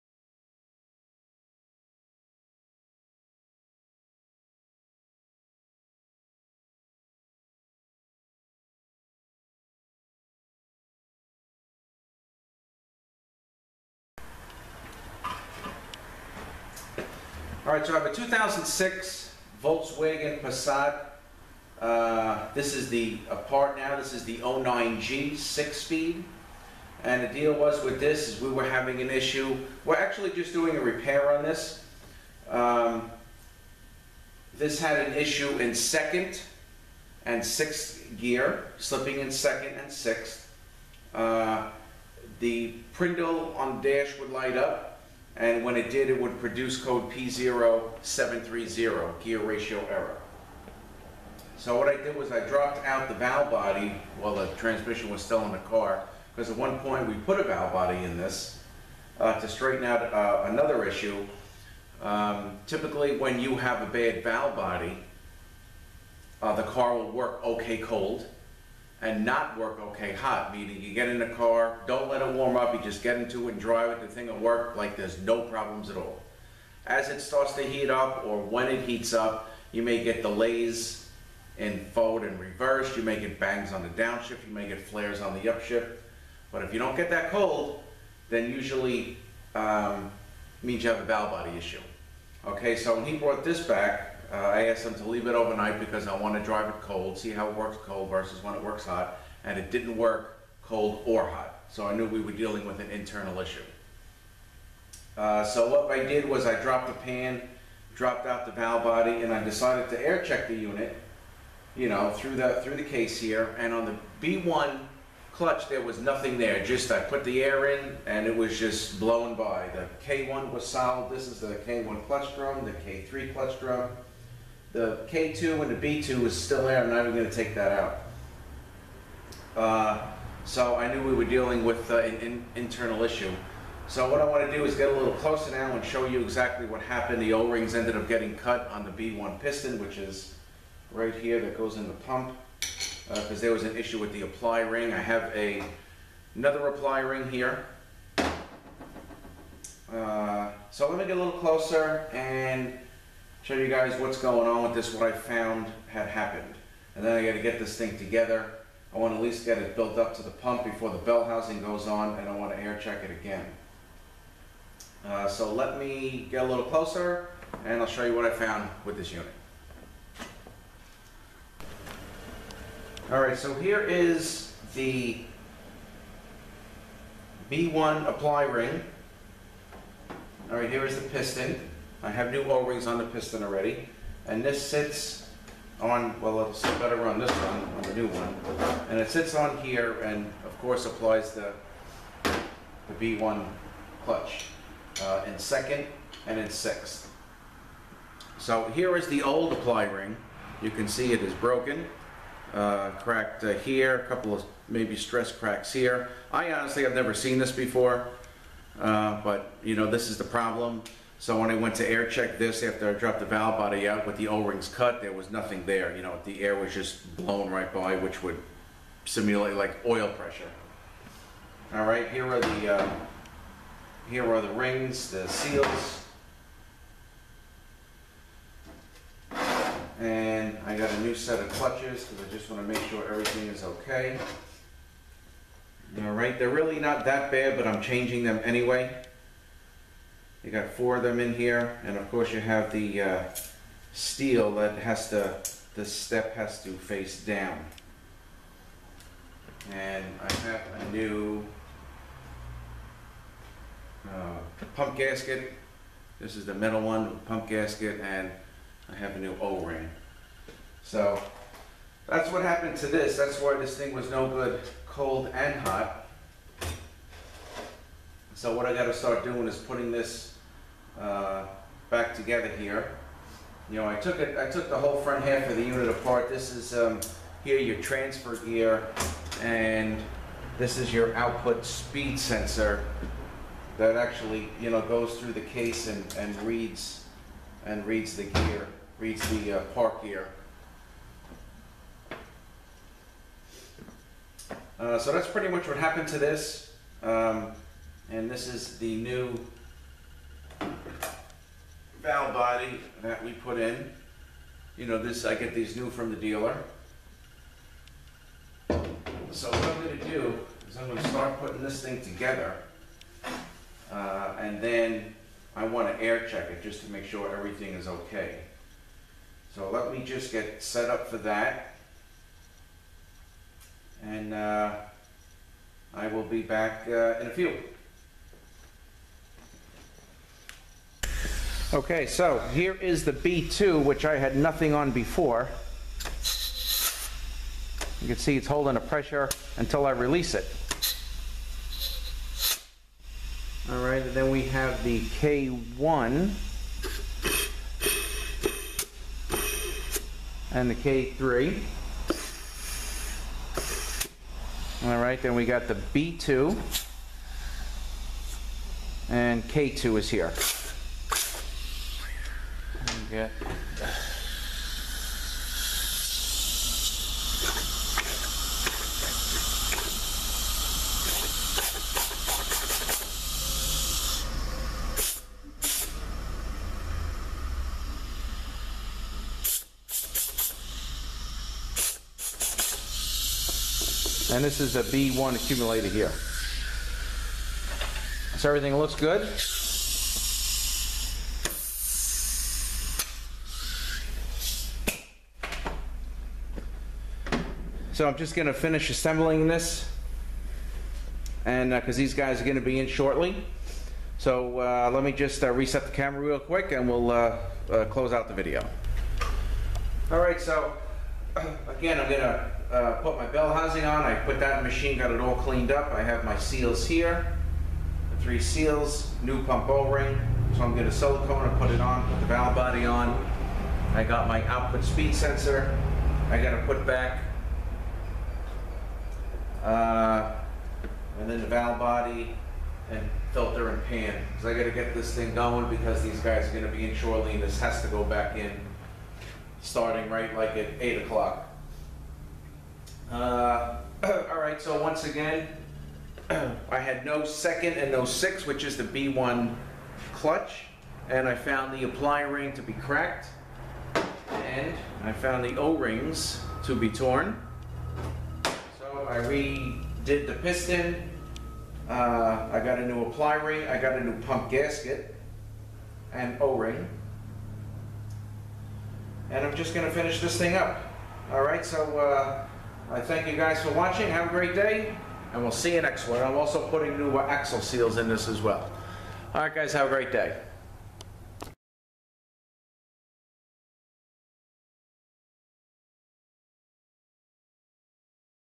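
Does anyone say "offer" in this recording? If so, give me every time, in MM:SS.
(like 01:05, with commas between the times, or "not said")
not said.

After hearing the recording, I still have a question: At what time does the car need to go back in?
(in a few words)
8 o'clock.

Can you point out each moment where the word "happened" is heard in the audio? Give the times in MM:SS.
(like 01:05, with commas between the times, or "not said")
02:16, 02:36, 04:22, 04:55.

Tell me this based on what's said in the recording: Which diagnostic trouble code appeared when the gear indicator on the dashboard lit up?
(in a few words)
P0730.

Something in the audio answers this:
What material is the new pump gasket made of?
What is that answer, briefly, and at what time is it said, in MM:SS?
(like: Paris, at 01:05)
metal, at 04:16.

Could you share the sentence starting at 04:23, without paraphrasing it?
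That's why this thing was no good cold and hot.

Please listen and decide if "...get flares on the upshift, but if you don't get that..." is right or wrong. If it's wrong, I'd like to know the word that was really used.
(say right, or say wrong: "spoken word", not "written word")
right.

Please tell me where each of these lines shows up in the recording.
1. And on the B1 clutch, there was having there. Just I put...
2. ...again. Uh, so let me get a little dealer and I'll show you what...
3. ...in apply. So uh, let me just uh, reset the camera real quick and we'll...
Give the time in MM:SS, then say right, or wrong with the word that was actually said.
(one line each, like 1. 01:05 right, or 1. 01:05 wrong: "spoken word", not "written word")
1. 01:53 wrong: "nothing", not "having"
2. 02:43 wrong: "closer", not "dealer"
3. 06:42 wrong: "shortly", not "apply".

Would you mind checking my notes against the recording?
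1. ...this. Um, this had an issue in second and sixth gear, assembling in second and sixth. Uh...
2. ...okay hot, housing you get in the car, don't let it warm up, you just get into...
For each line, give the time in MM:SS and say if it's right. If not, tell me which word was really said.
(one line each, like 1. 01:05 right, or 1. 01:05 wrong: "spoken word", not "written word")
1. 00:31 wrong: "slipping", not "assembling"
2. 01:09 wrong: "meaning", not "housing".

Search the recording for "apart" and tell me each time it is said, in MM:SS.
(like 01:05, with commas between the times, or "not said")
00:23, 04:35.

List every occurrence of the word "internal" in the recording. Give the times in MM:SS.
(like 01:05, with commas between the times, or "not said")
01:42, 02:12.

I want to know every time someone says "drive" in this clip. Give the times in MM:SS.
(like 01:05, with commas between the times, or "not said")
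01:13, 01:36.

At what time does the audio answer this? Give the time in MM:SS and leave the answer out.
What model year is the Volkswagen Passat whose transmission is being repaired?
00:18.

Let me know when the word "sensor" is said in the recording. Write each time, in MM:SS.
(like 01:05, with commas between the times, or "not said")
04:42, 07:05.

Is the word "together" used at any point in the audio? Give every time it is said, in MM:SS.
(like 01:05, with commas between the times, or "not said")
02:37, 04:32, 05:12.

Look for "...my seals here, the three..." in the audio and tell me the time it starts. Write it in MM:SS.
06:56.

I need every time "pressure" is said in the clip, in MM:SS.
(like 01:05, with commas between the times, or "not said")
03:40, 05:38.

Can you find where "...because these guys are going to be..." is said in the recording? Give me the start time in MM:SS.
07:15.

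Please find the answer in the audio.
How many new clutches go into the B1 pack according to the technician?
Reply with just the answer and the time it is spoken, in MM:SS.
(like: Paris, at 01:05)
4, at 04:00.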